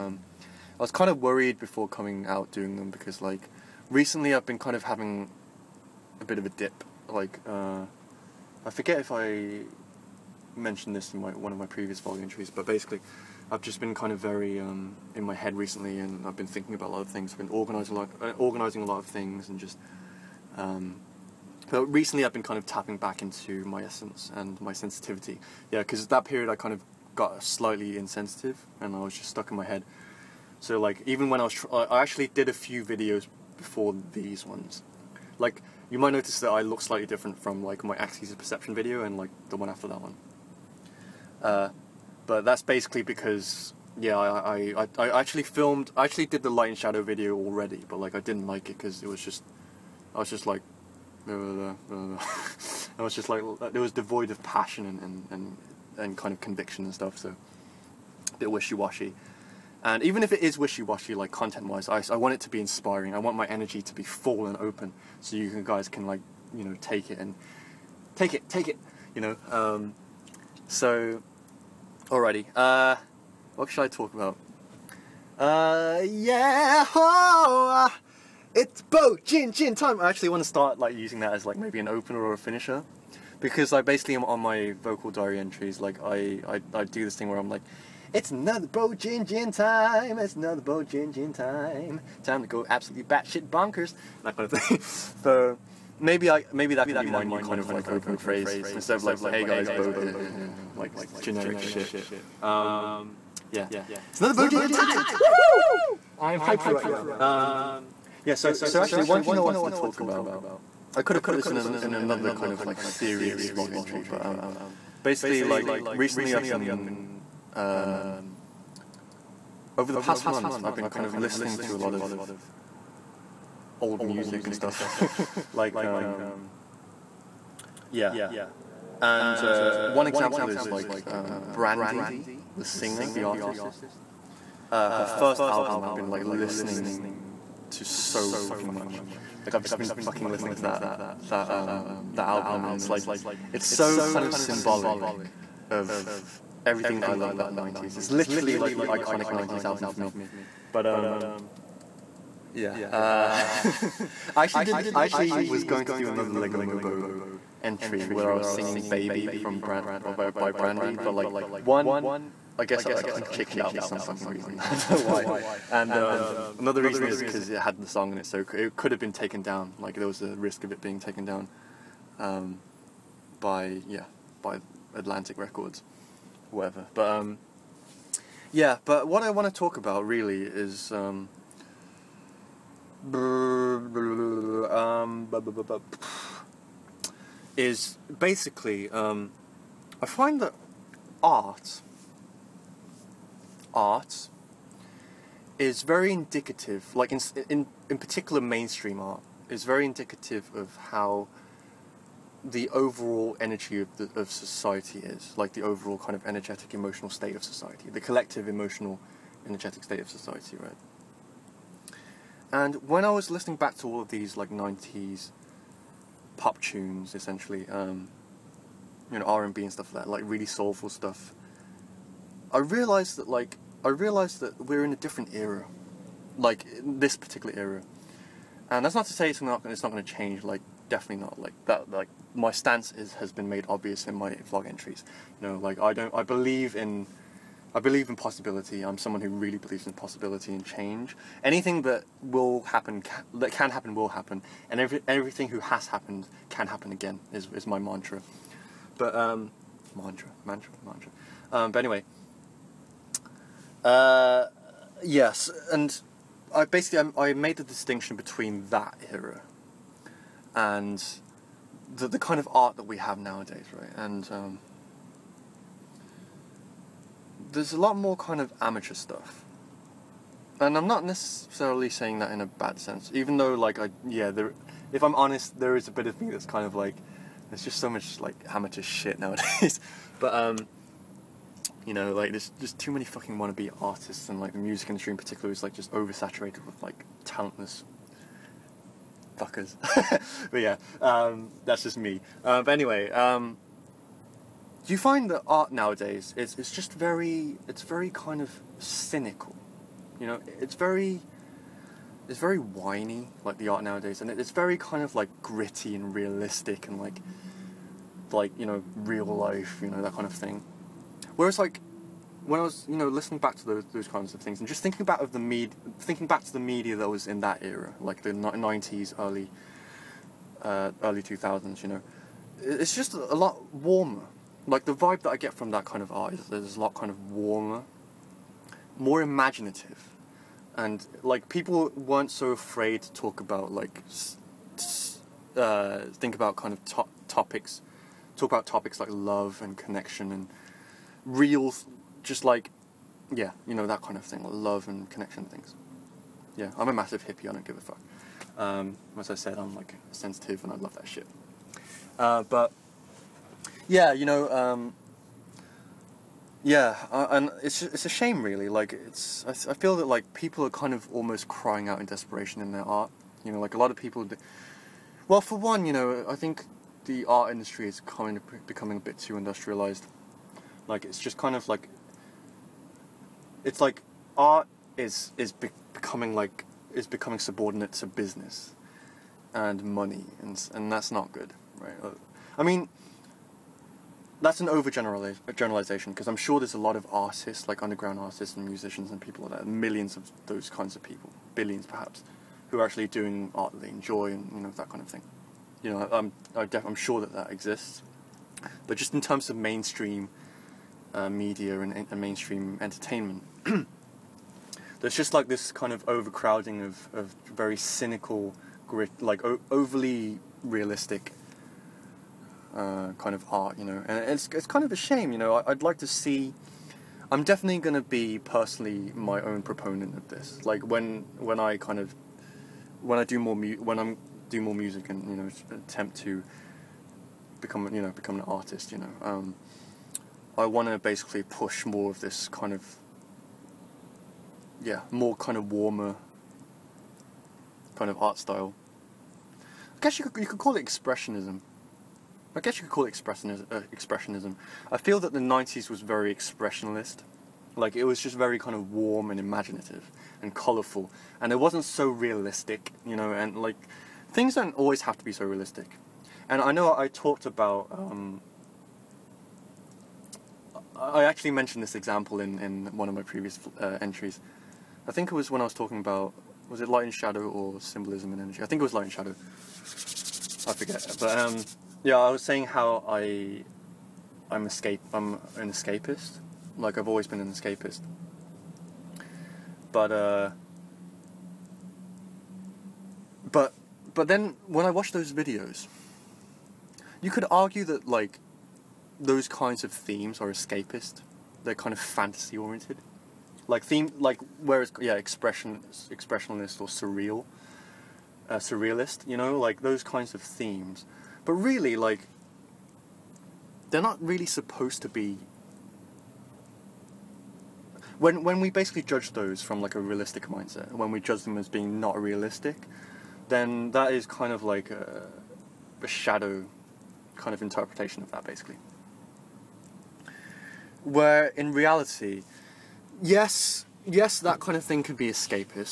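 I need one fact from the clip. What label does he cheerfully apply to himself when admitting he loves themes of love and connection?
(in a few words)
a massive hippie.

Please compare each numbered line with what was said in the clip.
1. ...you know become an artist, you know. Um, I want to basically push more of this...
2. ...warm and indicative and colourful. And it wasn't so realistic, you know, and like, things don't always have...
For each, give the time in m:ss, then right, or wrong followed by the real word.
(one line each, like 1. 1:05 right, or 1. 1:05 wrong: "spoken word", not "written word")
1. 7:07 right
2. 7:28 wrong: "imaginative", not "indicative".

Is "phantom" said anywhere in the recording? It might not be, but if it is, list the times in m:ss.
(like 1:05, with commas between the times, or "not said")
not said.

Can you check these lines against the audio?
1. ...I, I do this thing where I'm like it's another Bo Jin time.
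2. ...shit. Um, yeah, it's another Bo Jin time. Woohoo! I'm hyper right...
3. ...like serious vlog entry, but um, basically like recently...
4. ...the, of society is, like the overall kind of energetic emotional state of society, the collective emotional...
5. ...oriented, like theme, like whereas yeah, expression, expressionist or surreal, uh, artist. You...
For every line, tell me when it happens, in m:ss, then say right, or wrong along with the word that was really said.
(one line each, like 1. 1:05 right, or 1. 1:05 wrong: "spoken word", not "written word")
1. 1:26 right
2. 1:41 right
3. 1:52 right
4. 3:23 right
5. 8:12 wrong: "surrealist", not "artist".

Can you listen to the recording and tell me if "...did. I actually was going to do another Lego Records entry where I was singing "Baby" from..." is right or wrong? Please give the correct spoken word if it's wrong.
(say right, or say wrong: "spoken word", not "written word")
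wrong: "Mobo", not "Records".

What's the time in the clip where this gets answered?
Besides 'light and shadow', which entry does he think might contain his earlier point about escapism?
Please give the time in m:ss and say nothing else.
7:47.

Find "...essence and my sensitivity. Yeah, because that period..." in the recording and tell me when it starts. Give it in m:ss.
0:23.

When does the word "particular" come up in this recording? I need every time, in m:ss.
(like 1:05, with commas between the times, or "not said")
3:17, 3:47, 4:45.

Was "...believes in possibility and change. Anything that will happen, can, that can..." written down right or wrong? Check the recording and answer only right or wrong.
right.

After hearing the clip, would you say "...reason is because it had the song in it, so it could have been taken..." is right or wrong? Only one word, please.
right.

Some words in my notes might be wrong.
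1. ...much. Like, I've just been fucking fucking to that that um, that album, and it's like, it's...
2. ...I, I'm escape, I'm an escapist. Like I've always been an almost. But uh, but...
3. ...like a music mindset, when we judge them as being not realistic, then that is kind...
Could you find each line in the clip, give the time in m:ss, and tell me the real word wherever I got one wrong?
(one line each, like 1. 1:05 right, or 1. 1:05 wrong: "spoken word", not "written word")
1. 2:18 wrong: "listening", not "fucking"
2. 7:53 wrong: "escapist", not "almost"
3. 8:29 wrong: "realistic", not "music".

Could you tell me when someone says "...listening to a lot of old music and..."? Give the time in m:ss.
2:01.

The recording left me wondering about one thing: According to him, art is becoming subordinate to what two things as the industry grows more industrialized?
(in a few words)
business and money.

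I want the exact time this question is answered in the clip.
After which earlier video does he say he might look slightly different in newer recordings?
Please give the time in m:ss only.
0:37.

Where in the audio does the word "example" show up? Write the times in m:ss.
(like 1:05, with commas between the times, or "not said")
2:10, 7:41.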